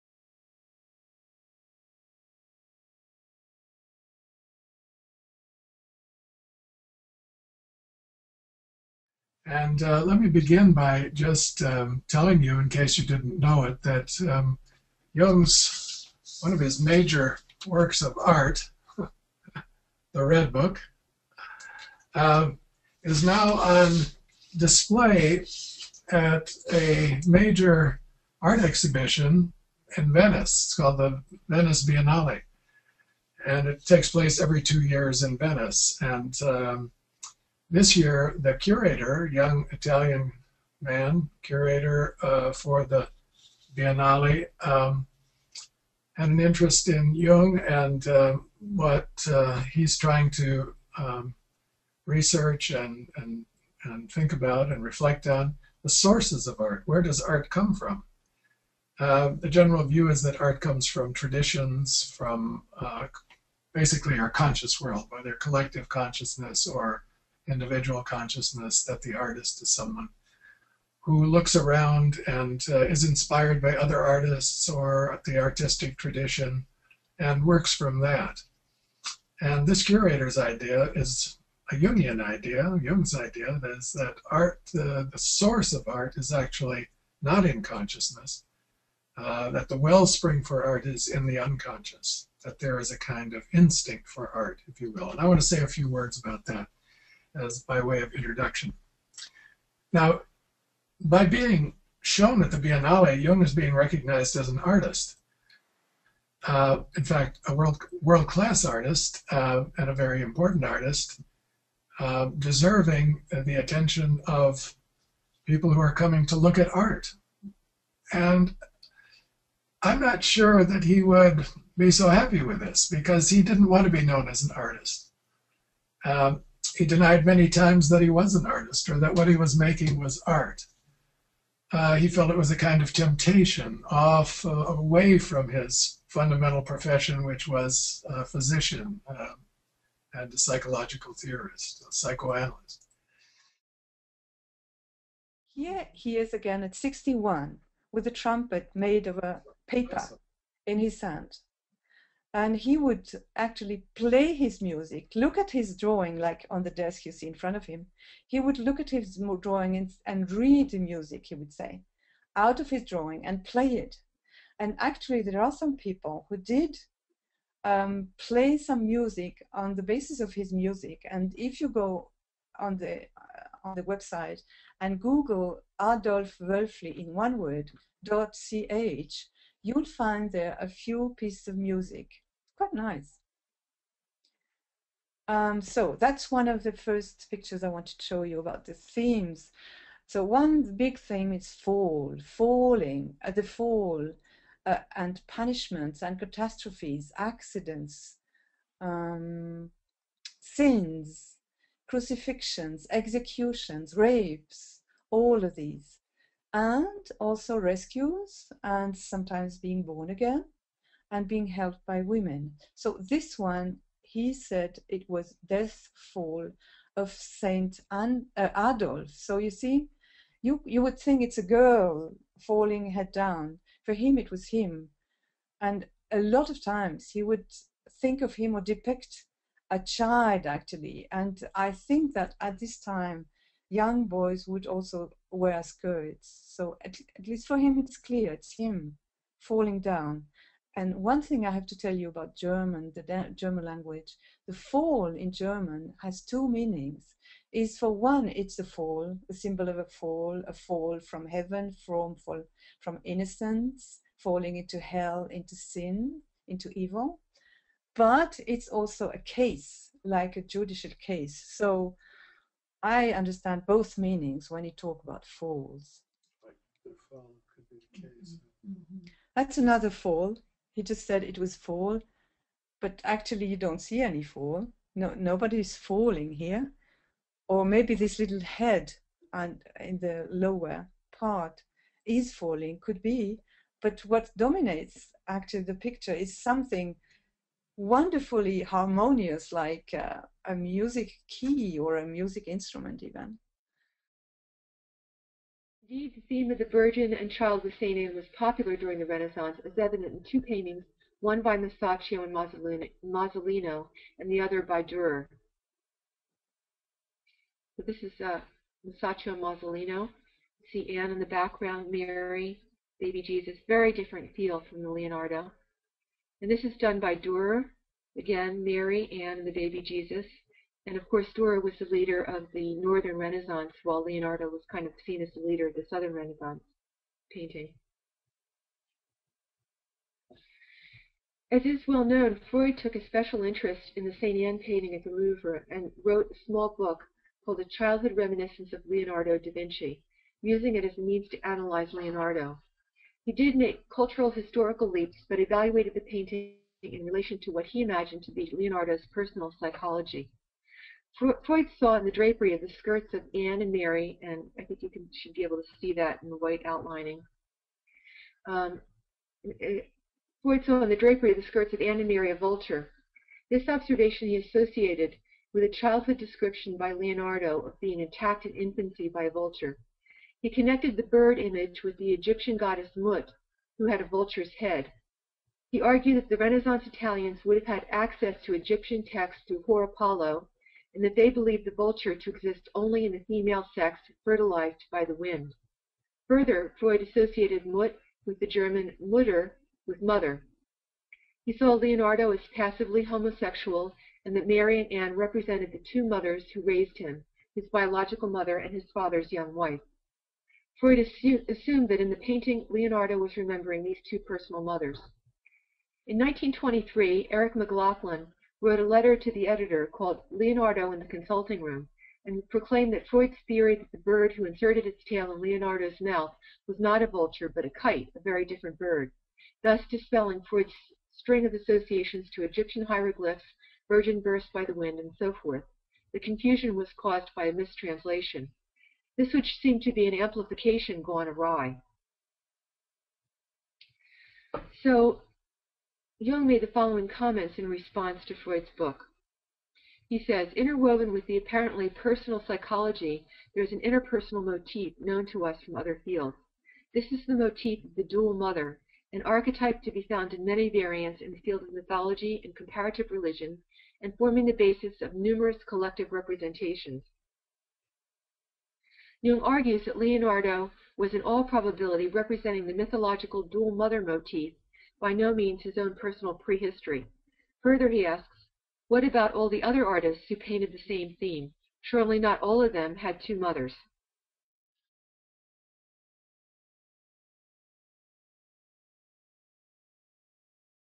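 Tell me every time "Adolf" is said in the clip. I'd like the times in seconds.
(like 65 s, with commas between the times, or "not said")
175 s, 218 s.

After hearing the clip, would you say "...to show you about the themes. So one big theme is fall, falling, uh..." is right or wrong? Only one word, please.
right.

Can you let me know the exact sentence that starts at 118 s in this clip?
And I'm not sure that he would be so happy with this because he didn't want to be known as an artist.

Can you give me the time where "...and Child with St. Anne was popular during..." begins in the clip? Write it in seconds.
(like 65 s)
297 s.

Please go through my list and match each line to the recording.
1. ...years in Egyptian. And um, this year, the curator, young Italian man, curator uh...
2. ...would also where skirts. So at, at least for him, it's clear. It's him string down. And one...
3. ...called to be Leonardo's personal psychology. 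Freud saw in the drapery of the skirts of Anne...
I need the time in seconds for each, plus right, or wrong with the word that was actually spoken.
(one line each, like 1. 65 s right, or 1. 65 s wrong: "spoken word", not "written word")
1. 34 s wrong: "Venice", not "Egyptian"
2. 234 s wrong: "falling", not "string"
3. 347 s wrong: "imagined", not "called".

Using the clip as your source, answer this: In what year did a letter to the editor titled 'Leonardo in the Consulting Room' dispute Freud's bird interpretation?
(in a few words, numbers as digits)
1923.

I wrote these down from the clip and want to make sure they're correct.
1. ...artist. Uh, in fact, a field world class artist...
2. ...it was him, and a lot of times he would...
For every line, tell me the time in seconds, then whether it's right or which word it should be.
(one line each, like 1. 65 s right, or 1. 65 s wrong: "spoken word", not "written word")
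1. 104 s wrong: "world", not "field"
2. 224 s right.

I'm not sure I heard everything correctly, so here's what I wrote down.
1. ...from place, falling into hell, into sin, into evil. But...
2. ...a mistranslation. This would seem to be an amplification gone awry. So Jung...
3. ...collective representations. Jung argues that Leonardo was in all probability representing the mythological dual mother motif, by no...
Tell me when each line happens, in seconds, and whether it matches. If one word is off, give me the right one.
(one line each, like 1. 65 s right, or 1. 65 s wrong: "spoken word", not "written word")
1. 252 s wrong: "innocence", not "place"
2. 427 s right
3. 455 s right.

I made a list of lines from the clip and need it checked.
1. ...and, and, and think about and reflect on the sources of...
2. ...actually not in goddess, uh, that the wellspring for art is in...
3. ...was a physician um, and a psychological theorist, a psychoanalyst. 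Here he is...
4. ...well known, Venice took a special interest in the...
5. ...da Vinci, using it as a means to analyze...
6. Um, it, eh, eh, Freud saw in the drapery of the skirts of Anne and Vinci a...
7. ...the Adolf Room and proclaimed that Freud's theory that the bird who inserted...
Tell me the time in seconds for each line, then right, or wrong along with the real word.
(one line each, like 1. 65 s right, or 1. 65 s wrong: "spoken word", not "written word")
1. 52 s right
2. 86 s wrong: "consciousness", not "goddess"
3. 137 s right
4. 331 s wrong: "Freud", not "Venice"
5. 339 s right
6. 358 s wrong: "Mary", not "Vinci"
7. 410 s wrong: "Consulting", not "Adolf".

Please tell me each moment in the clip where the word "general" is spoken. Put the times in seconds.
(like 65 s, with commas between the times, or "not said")
59 s.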